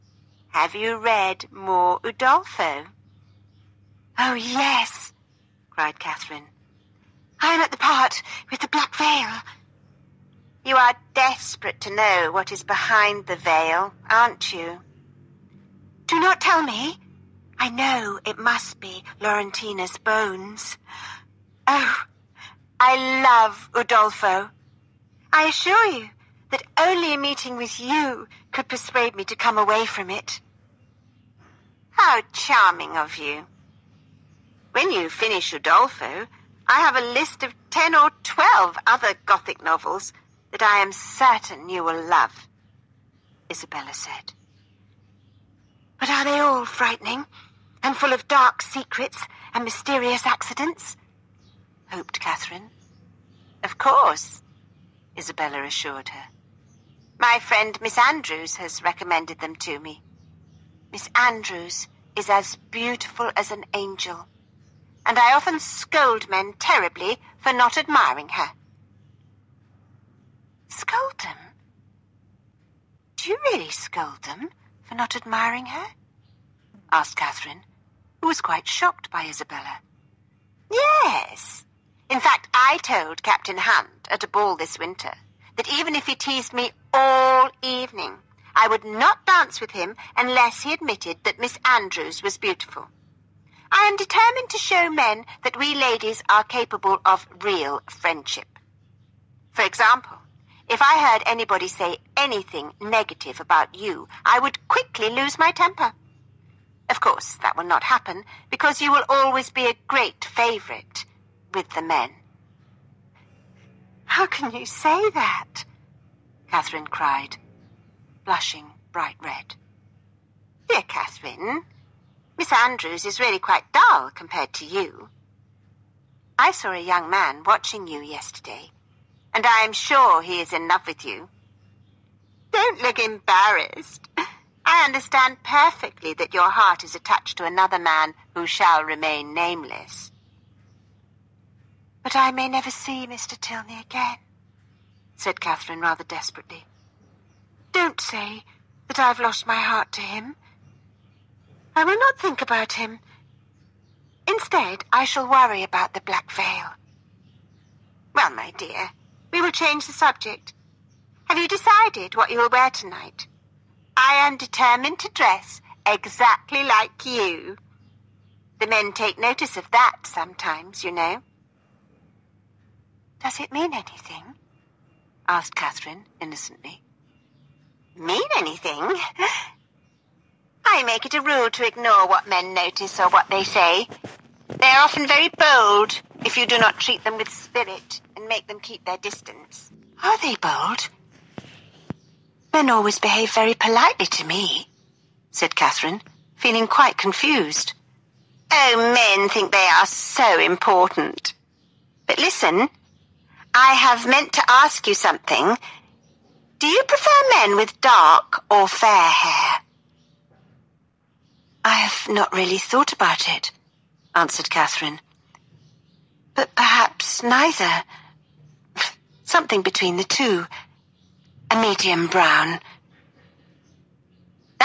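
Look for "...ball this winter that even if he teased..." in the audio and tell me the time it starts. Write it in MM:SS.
01:24.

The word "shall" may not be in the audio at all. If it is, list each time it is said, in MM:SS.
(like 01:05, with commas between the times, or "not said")
02:18, 02:35.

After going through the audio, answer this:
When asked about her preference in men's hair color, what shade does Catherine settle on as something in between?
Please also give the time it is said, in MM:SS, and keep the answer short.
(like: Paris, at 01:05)
medium brown, at 03:41.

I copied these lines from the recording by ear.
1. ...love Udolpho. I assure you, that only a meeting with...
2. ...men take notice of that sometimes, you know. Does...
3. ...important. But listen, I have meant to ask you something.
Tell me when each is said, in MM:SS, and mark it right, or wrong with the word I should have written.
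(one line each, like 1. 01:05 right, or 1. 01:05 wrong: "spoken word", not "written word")
1. 00:23 right
2. 02:48 right
3. 03:20 right.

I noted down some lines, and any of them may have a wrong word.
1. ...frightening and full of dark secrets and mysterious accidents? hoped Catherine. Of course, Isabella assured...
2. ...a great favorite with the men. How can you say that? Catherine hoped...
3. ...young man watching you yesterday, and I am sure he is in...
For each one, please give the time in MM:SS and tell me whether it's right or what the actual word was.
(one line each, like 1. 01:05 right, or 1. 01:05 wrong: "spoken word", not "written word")
1. 00:46 right
2. 01:49 wrong: "cried", not "hoped"
3. 02:06 right.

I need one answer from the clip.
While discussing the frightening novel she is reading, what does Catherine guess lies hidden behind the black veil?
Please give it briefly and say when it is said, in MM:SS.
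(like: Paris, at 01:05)
Laurentina's bones, at 00:19.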